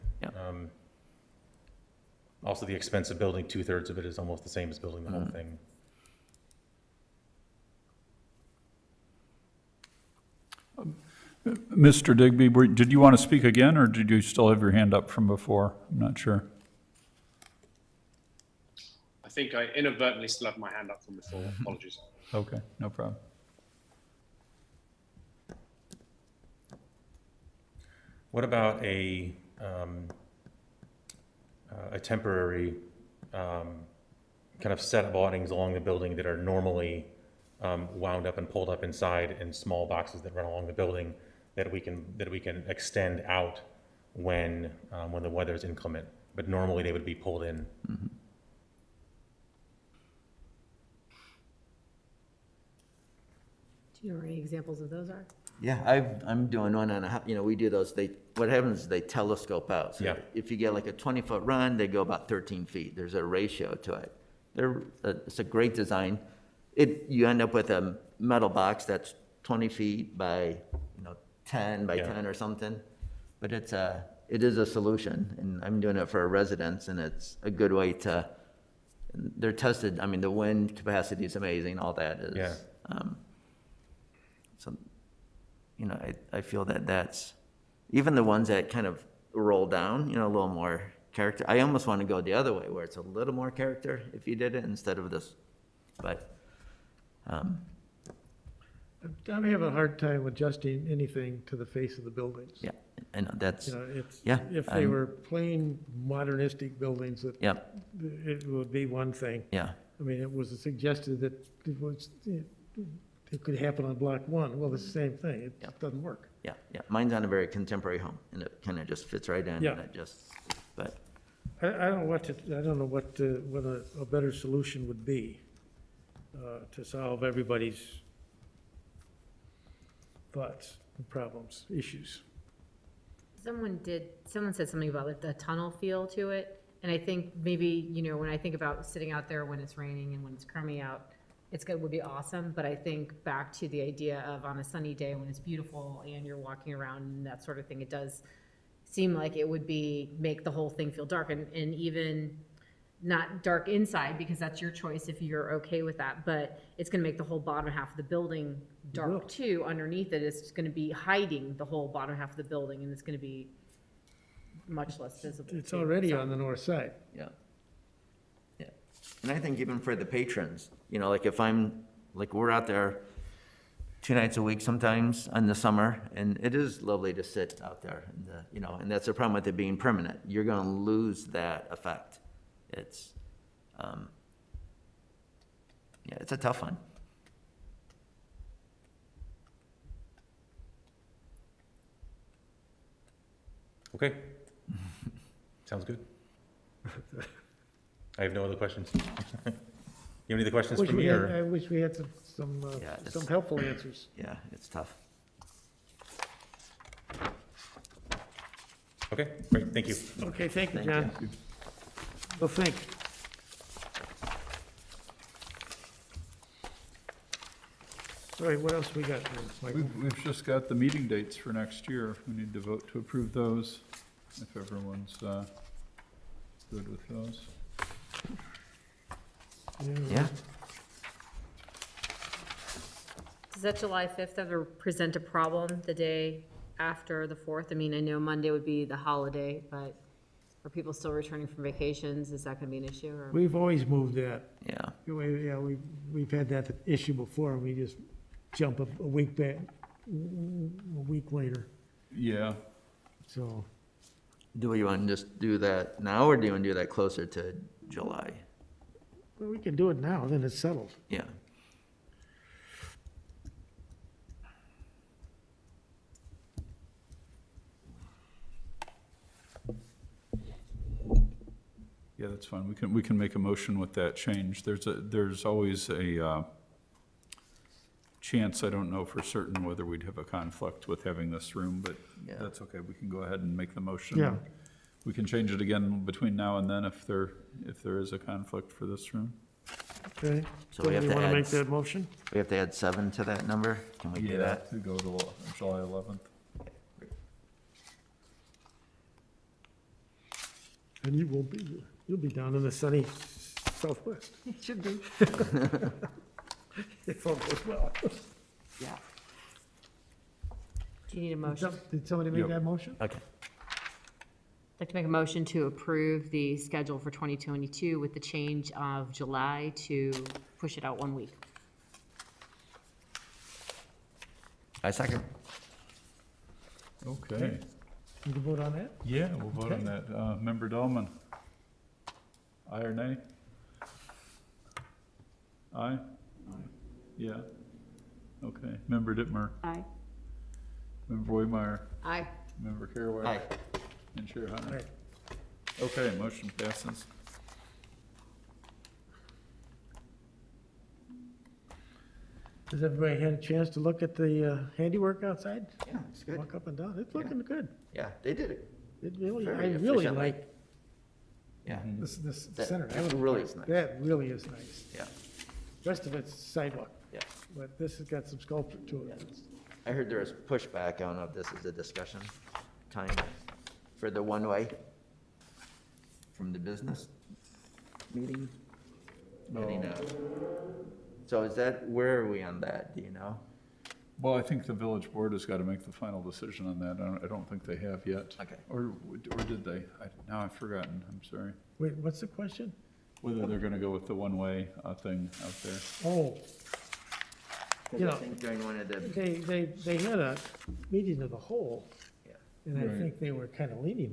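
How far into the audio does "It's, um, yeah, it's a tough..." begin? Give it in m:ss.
3:02.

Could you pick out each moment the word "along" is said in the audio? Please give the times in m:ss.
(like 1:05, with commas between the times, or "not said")
0:35, 0:40.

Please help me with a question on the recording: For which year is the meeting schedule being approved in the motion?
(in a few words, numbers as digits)
2022.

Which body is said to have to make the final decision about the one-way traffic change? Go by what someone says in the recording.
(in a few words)
the village board.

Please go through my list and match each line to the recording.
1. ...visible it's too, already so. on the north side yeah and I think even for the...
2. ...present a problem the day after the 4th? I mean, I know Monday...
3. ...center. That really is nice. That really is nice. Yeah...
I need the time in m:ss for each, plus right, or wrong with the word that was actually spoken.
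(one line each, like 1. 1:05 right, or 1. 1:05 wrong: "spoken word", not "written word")
1. 2:45 right
2. 3:54 right
3. 6:02 right.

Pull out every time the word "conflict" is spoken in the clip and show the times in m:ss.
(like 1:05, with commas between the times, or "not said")
4:40, 4:48.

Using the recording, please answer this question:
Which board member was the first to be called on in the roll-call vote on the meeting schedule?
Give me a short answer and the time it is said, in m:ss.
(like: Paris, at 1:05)
Dahlman, at 5:30.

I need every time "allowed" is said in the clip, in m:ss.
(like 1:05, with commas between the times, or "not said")
not said.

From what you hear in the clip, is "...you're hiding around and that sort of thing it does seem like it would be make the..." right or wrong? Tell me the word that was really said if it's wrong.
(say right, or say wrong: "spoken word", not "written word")
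wrong: "walking", not "hiding".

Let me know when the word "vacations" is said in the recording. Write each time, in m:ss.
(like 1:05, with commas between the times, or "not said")
4:01.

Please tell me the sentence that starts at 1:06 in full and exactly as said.
It, you end up with a metal box that's twenty feet by, you know, ten by Yeah.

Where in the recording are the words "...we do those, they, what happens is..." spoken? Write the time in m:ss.
0:57.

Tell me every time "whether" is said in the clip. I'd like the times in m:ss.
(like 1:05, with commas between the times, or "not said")
4:39, 6:33.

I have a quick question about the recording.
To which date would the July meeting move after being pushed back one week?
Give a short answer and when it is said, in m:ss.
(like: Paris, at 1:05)
July 11, at 4:55.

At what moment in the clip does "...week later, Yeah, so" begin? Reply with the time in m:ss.
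4:11.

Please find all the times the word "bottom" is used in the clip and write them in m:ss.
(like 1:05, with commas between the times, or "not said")
2:37, 2:41.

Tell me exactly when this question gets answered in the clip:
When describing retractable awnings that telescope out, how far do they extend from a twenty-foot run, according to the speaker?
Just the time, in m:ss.
1:02.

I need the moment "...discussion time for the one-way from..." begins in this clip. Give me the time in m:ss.
6:11.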